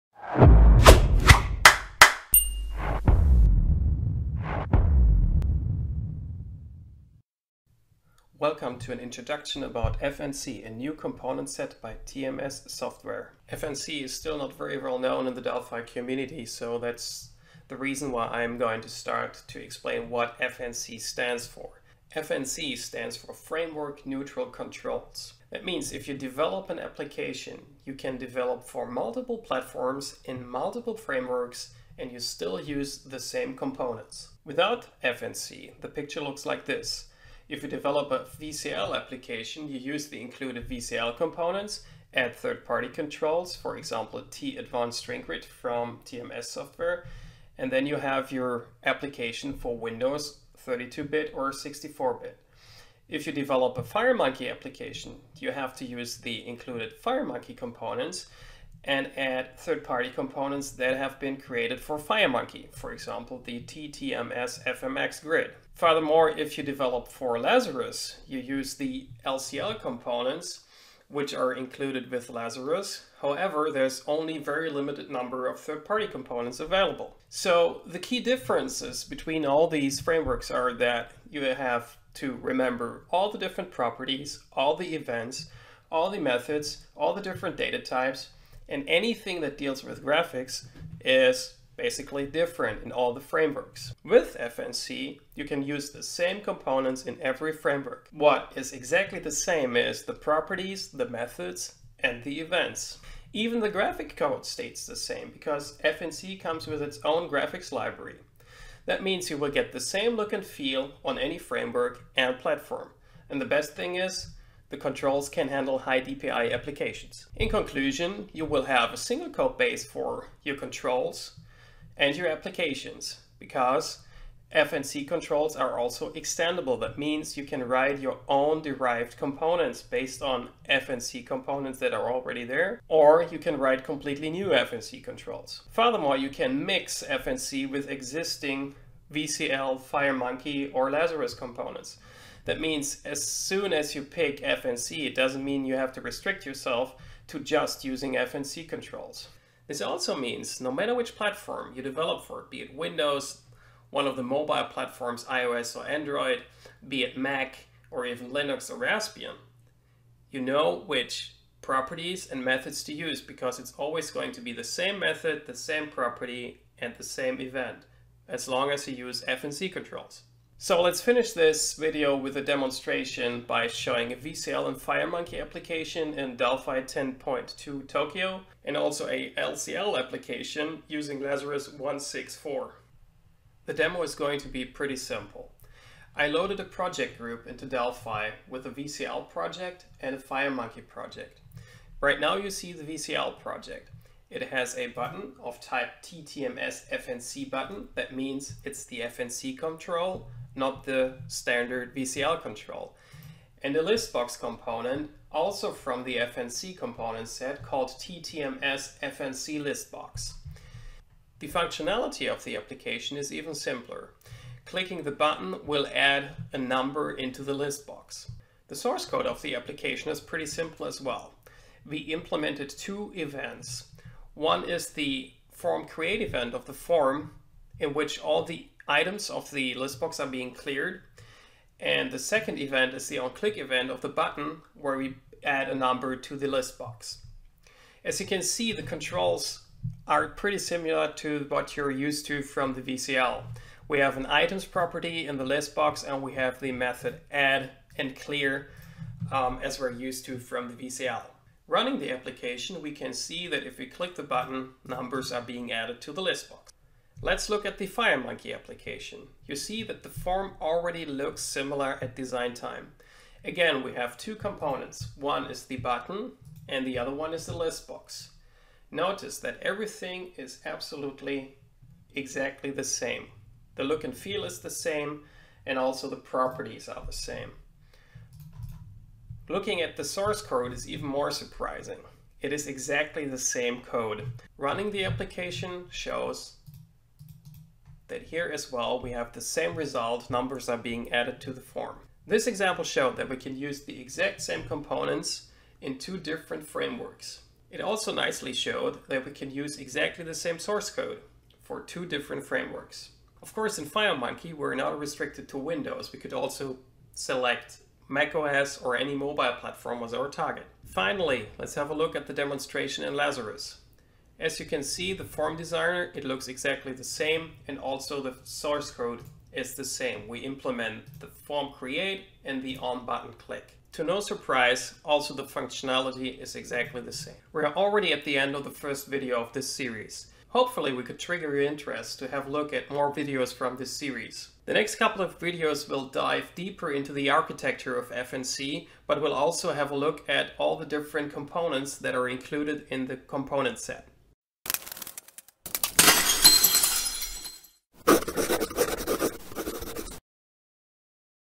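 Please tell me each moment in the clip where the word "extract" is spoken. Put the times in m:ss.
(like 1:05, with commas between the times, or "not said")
not said.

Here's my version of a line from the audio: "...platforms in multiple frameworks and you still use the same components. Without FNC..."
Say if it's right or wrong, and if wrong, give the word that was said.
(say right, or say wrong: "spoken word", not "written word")
right.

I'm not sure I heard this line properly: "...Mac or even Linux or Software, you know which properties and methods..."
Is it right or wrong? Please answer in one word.
wrong.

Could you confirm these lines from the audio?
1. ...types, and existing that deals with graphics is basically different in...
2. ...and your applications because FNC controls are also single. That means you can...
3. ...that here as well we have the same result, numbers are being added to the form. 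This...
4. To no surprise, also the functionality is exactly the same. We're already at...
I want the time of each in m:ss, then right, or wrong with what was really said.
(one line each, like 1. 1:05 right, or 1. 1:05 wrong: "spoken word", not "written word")
1. 1:27 wrong: "anything", not "existing"
2. 2:02 wrong: "extendable", not "single"
3. 4:48 right
4. 5:23 right.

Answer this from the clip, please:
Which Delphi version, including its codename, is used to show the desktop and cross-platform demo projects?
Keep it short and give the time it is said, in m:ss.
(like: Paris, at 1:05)
Delphi 10.2 Tokyo, at 2:56.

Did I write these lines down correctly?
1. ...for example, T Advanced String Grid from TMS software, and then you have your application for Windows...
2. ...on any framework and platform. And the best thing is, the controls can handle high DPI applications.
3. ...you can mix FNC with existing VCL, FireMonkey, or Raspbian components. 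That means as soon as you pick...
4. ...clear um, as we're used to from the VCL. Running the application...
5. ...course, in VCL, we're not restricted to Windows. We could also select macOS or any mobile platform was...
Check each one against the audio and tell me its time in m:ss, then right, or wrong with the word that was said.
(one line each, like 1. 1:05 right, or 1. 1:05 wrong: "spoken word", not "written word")
1. 0:43 right
2. 1:51 right
3. 2:16 wrong: "Lazarus", not "Raspbian"
4. 4:08 right
5. 5:03 wrong: "FireMonkey", not "VCL".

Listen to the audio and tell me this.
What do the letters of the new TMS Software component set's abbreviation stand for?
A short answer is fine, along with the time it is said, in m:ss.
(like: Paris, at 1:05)
Framework Neutral Controls, at 0:23.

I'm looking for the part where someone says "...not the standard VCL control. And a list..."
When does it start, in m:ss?
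3:20.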